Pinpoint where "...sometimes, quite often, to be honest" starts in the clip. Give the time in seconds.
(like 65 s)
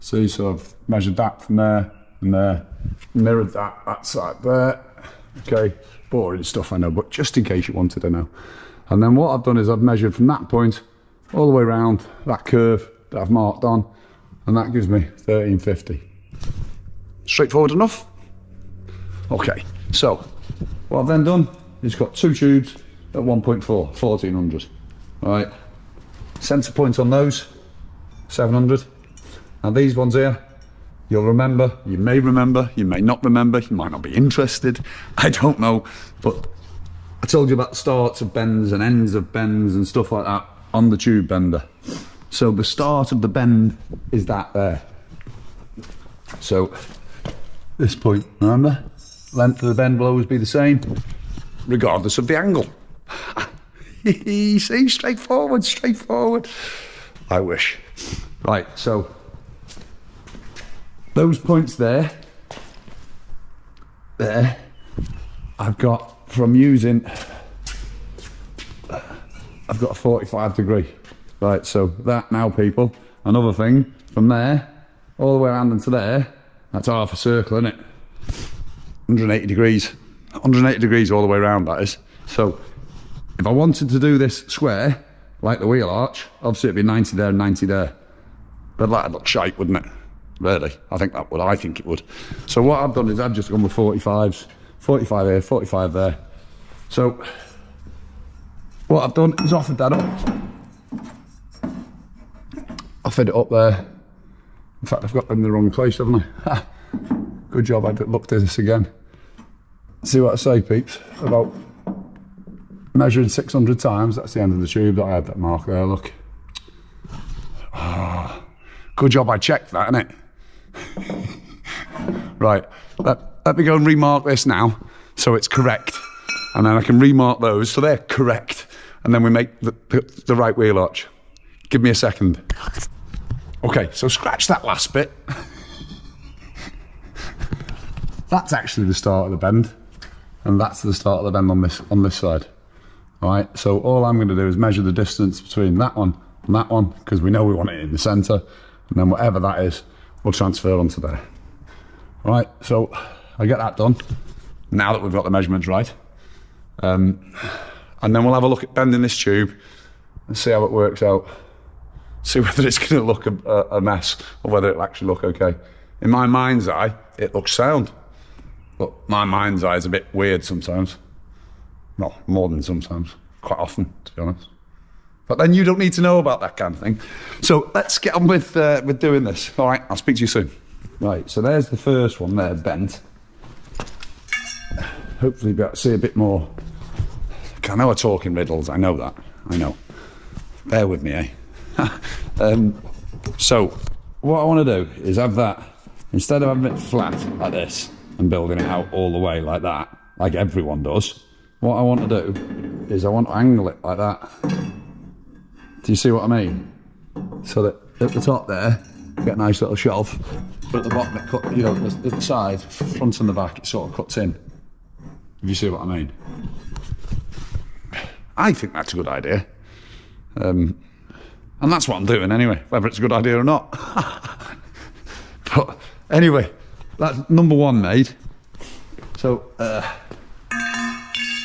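172 s.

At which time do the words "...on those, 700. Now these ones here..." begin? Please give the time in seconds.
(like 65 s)
26 s.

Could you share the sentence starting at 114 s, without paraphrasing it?
That's the end of the tube that I had that mark there, look.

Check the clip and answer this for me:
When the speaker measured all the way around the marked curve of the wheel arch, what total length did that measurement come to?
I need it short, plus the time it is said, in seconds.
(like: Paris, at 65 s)
1350, at 14 s.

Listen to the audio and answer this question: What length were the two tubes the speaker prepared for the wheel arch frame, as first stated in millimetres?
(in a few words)
1400.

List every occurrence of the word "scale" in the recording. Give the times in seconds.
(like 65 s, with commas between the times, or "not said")
not said.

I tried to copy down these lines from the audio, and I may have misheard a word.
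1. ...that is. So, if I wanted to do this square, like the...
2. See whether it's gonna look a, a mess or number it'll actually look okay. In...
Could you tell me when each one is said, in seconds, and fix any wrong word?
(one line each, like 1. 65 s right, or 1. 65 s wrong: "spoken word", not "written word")
1. 81 s right
2. 162 s wrong: "whether", not "number".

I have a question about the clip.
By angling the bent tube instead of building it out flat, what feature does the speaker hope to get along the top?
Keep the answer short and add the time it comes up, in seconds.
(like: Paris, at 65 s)
a nice little shelf, at 209 s.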